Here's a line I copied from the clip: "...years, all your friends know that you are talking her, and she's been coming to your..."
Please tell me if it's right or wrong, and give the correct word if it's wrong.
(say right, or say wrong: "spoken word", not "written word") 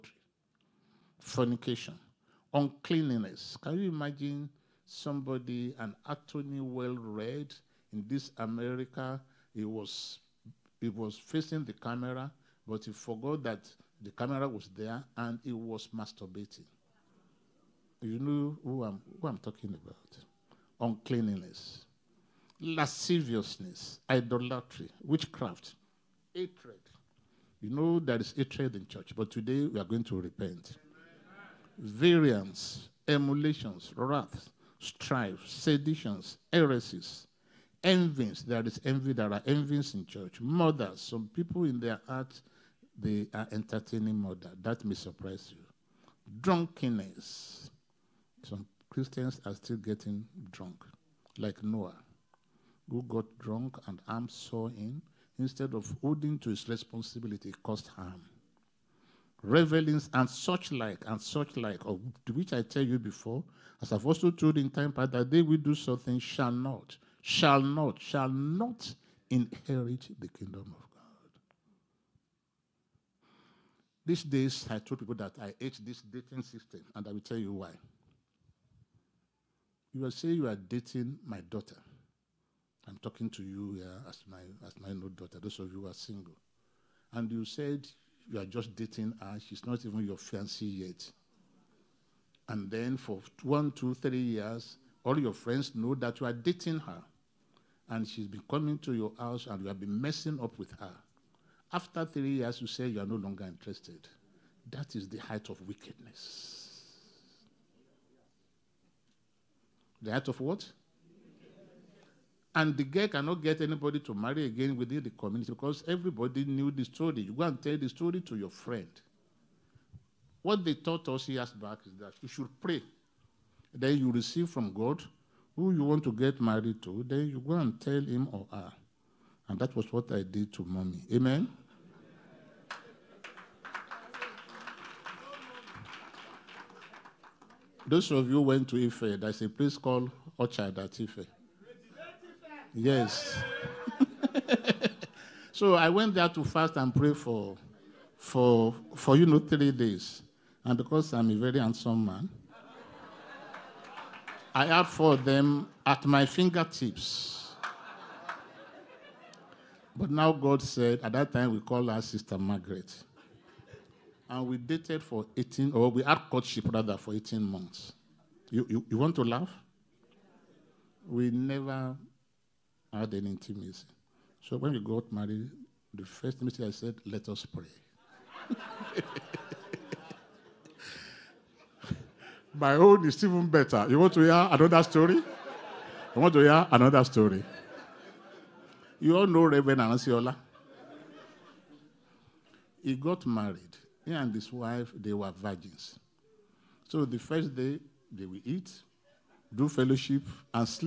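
wrong: "dating", not "talking".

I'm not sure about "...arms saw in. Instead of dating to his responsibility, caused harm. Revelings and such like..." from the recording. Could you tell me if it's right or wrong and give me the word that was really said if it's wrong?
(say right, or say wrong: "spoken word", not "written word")
wrong: "holding", not "dating".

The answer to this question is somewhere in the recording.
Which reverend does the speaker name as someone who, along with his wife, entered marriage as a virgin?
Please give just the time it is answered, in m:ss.
3:09.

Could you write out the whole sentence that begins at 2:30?
And because I'm a very handsome man, I had for them at my fingertips.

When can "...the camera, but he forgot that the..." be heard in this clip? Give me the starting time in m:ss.
0:11.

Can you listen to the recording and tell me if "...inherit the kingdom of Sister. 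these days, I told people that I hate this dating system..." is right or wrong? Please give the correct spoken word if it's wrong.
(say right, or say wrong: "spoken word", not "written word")
wrong: "God", not "Sister".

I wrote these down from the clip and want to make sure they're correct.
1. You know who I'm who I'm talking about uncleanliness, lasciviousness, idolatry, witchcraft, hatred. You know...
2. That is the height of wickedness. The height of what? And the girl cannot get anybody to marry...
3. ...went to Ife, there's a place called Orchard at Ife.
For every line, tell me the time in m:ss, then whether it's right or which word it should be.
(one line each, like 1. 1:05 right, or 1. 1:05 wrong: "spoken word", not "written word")
1. 0:18 right
2. 1:44 right
3. 2:18 right.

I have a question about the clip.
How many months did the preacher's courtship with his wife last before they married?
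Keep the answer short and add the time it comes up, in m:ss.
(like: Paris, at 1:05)
18, at 2:47.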